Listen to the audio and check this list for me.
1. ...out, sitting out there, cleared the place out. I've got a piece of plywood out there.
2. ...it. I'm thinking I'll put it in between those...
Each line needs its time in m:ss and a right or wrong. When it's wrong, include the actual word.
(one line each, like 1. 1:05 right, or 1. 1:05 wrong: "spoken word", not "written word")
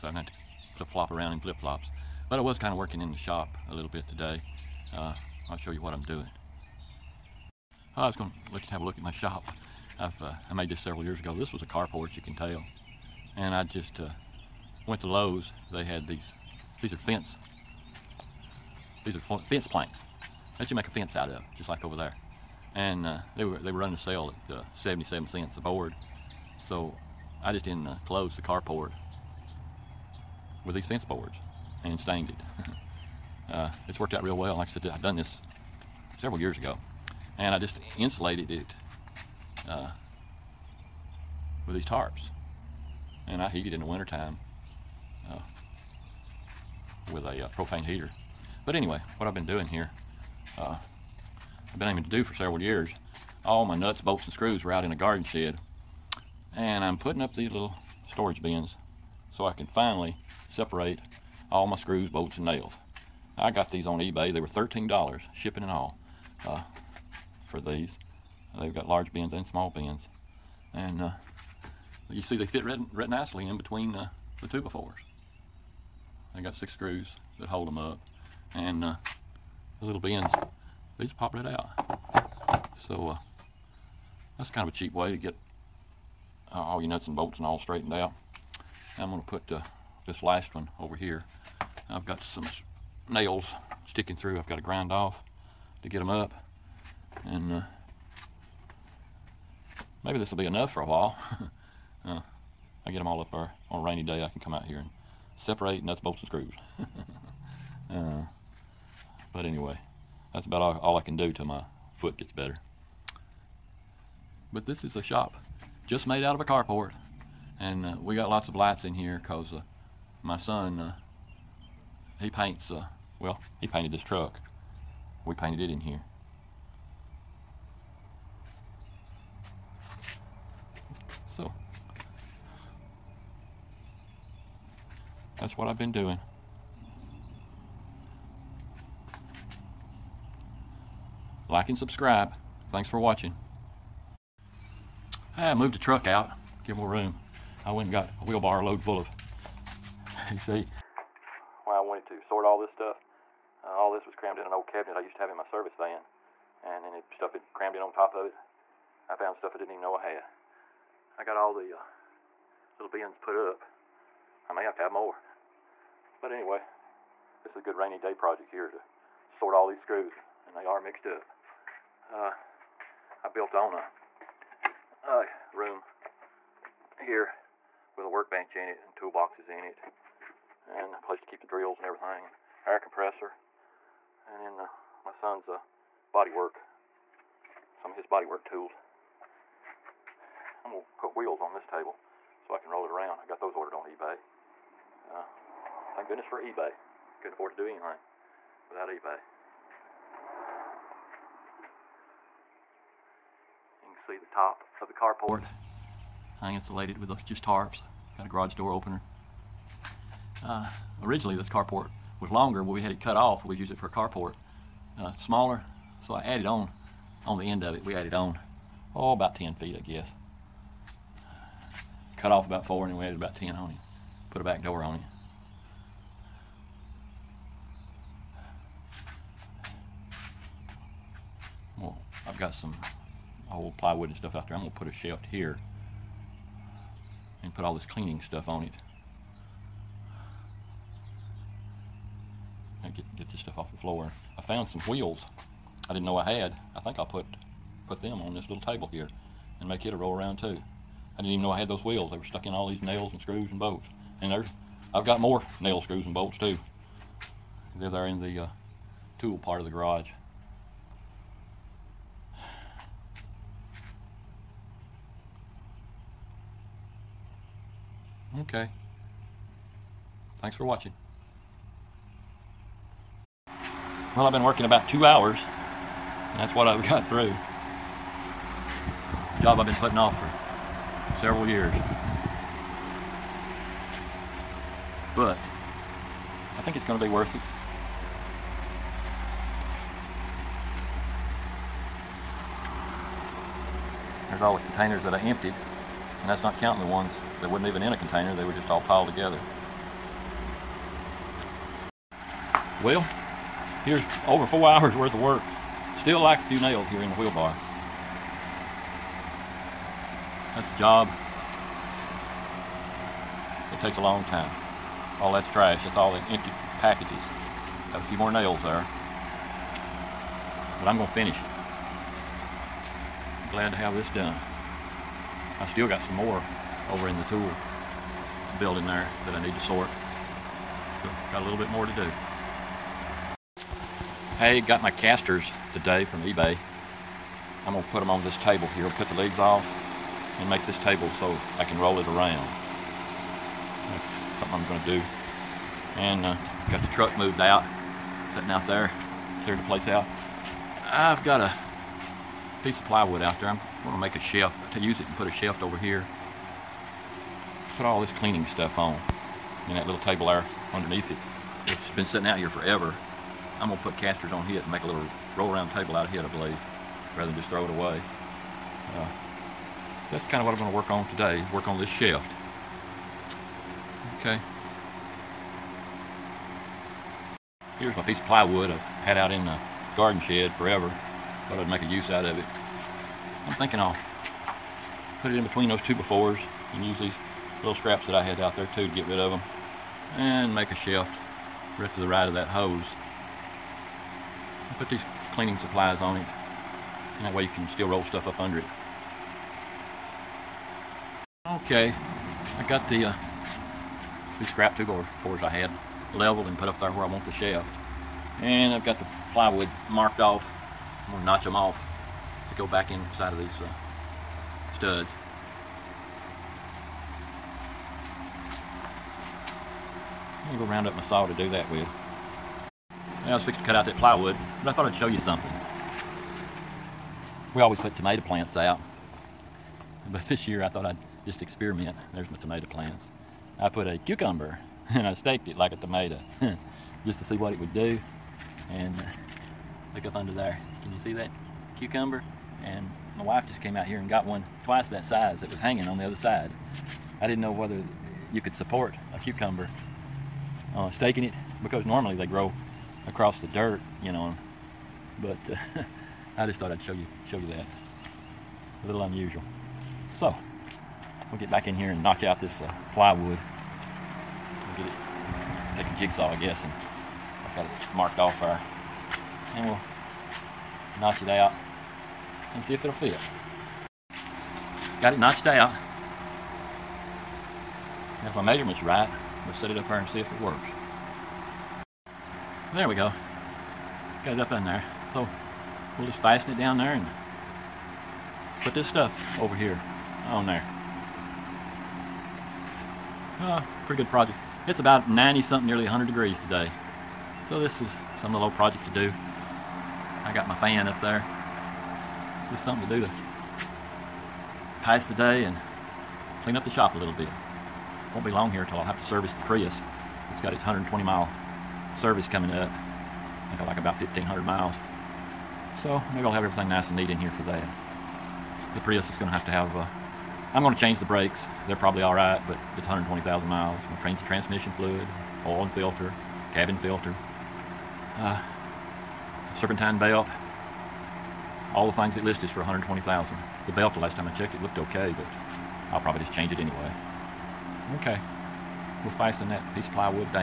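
1. 5:47 right
2. 6:22 right.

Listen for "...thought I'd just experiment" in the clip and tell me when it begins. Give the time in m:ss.
7:10.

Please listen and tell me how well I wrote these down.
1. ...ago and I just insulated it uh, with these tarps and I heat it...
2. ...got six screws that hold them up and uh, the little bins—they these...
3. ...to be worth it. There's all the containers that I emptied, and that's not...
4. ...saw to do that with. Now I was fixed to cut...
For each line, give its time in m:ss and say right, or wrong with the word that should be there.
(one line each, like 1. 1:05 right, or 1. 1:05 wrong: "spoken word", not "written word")
1. 0:36 right
2. 1:16 right
3. 4:46 right
4. 7:01 right.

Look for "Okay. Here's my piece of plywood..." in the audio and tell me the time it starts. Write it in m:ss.
6:14.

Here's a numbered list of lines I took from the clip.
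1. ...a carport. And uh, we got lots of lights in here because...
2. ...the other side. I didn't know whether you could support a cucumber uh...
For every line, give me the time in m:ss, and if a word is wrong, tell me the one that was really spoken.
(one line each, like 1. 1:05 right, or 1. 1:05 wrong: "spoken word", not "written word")
1. 1:56 right
2. 7:25 right.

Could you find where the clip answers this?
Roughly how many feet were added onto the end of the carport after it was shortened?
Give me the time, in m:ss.
3:39.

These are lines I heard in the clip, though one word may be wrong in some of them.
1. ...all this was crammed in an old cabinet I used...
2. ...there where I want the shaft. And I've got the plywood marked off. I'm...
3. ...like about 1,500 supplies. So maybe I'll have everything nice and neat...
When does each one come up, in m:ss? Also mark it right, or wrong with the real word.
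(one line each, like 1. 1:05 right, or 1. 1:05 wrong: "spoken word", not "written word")
1. 2:33 right
2. 6:46 right
3. 8:33 wrong: "miles", not "supplies".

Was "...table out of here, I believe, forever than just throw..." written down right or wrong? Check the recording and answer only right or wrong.
wrong.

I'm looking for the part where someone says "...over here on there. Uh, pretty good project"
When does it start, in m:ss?
8:09.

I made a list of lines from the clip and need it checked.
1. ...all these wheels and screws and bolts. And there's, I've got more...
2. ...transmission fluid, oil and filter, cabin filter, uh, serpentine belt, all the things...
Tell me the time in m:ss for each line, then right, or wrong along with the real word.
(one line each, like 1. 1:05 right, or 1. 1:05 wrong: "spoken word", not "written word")
1. 4:12 wrong: "nails", not "wheels"
2. 8:44 right.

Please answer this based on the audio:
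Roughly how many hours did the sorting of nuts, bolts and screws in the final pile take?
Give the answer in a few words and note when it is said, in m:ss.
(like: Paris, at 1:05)
Over four hours, at 5:04.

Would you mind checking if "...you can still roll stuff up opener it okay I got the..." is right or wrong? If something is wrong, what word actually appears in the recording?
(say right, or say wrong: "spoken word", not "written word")
wrong: "under", not "opener".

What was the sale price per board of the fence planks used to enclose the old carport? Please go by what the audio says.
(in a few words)
77 cents.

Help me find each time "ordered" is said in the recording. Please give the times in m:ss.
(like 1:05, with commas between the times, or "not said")
3:13.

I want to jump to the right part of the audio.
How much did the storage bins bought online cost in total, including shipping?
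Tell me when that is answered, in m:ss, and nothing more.
1:04.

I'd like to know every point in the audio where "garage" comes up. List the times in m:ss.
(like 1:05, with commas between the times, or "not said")
3:28, 4:19.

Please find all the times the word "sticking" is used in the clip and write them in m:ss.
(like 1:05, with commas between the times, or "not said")
1:33.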